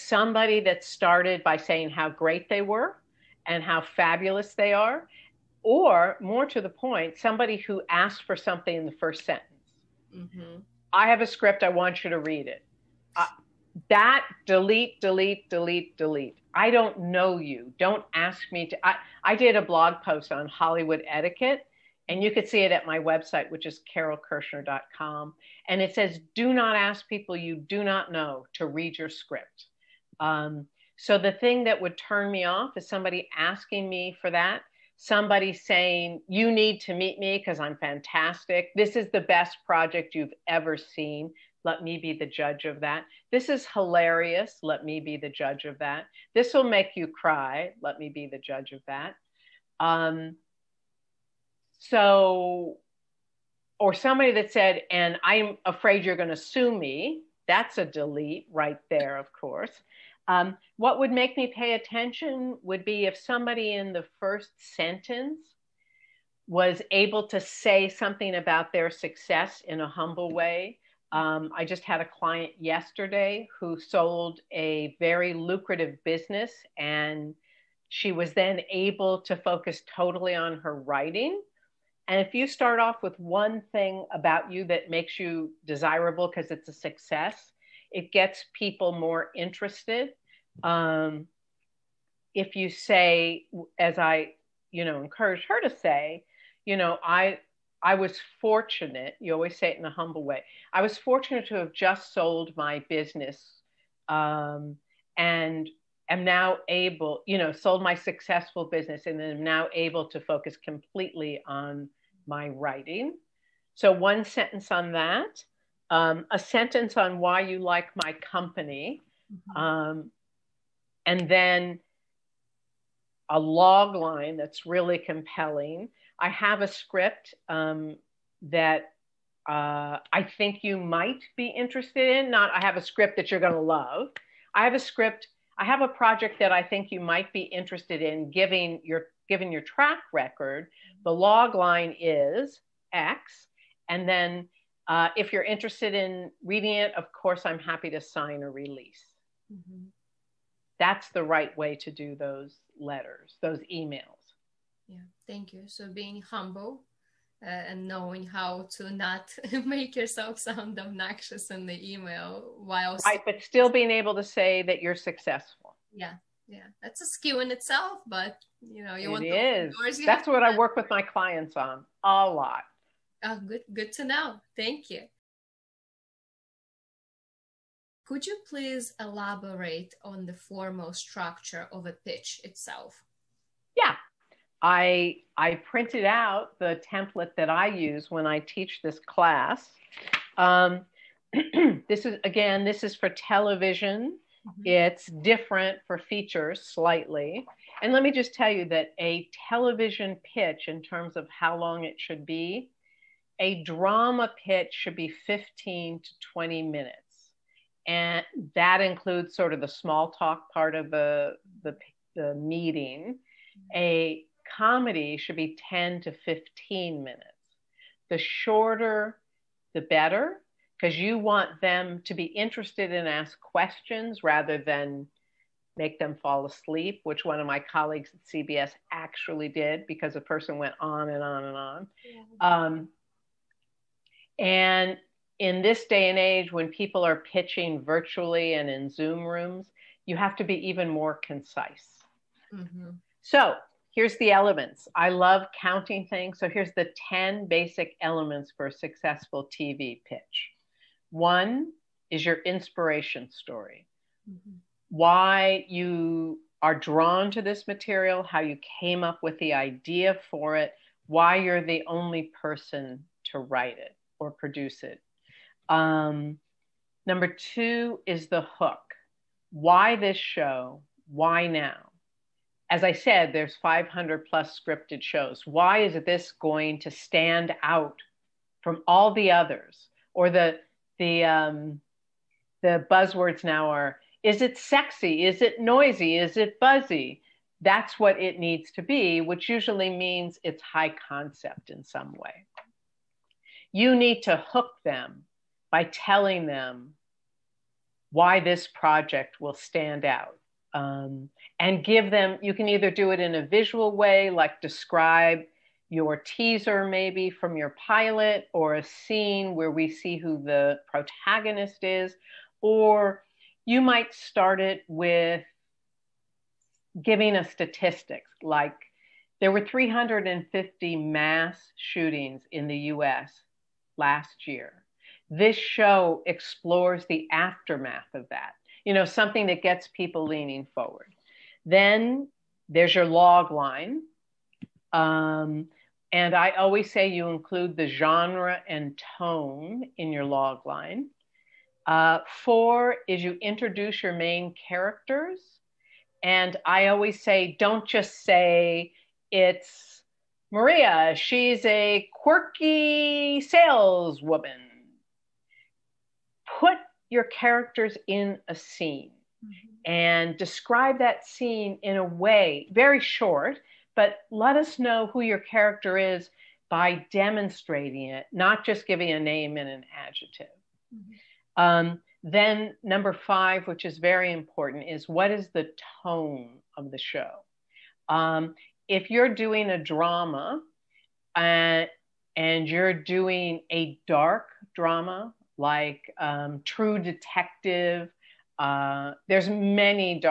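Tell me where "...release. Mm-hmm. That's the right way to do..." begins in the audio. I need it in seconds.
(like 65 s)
148 s.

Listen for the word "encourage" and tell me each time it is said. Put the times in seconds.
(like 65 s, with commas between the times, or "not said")
94 s.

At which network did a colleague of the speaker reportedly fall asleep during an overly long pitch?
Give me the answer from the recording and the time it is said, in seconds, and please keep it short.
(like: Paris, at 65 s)
CBS, at 228 s.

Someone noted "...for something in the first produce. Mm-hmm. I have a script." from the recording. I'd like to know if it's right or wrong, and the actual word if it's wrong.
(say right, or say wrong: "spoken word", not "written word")
wrong: "sentence", not "produce".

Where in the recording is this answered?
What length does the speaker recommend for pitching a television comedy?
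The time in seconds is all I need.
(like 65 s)
215 s.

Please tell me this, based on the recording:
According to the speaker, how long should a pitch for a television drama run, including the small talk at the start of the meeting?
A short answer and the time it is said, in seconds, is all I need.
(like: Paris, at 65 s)
15 to 20 minutes, at 205 s.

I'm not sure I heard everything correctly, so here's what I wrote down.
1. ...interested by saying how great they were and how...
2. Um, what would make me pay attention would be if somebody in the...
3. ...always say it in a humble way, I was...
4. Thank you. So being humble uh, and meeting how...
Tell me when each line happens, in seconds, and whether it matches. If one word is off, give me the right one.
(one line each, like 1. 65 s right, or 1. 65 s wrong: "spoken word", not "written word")
1. 0 s wrong: "started", not "interested"
2. 60 s right
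3. 99 s right
4. 155 s wrong: "knowing", not "meeting".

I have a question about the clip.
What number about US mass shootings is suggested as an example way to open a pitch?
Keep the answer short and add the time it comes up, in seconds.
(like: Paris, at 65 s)
350, at 319 s.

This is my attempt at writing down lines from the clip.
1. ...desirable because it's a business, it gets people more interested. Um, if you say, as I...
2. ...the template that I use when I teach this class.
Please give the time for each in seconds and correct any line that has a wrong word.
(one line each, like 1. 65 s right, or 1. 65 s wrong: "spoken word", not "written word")
1. 85 s wrong: "success", not "business"
2. 186 s right.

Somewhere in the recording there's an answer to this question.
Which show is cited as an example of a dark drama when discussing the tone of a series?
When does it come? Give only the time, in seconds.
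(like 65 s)
386 s.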